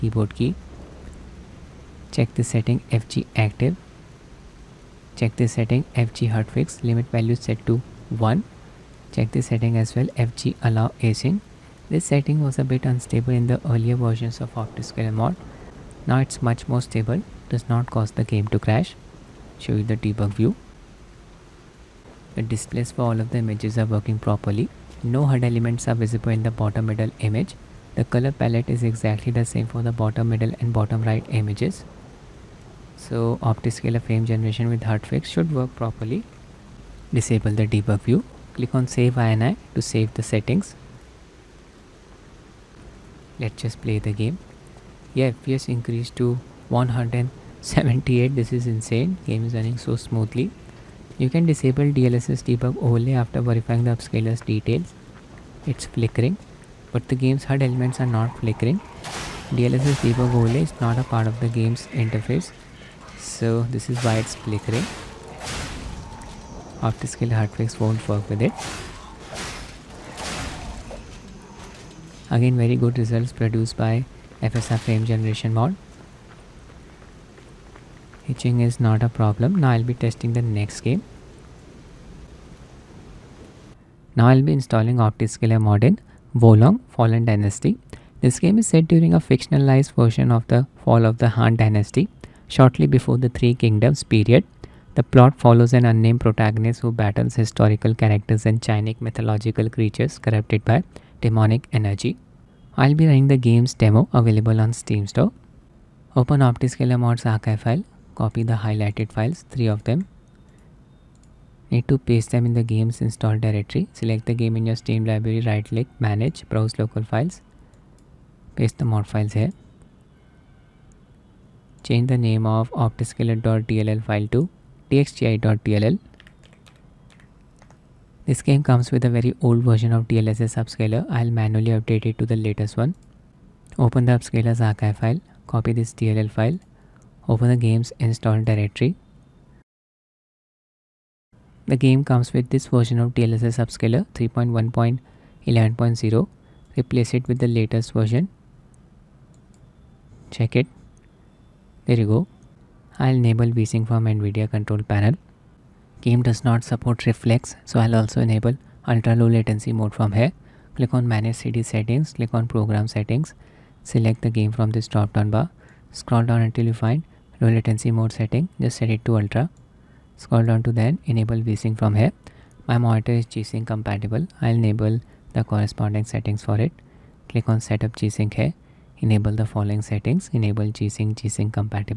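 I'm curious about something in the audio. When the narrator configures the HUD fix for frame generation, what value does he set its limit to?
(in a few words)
1.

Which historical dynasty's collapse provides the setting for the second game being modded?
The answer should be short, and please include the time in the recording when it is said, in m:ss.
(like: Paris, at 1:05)
Han Dynasty, at 1:31.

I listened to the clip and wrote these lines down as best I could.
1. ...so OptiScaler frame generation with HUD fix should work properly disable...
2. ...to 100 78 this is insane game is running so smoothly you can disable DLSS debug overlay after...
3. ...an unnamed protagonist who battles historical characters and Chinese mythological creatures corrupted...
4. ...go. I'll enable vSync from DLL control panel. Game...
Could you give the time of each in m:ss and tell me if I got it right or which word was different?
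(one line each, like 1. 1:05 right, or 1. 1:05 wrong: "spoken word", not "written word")
1. 0:32 right
2. 0:46 right
3. 1:35 right
4. 2:32 wrong: "NVIDIA", not "DLL".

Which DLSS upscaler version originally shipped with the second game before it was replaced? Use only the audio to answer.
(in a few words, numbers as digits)
3.1.11.0.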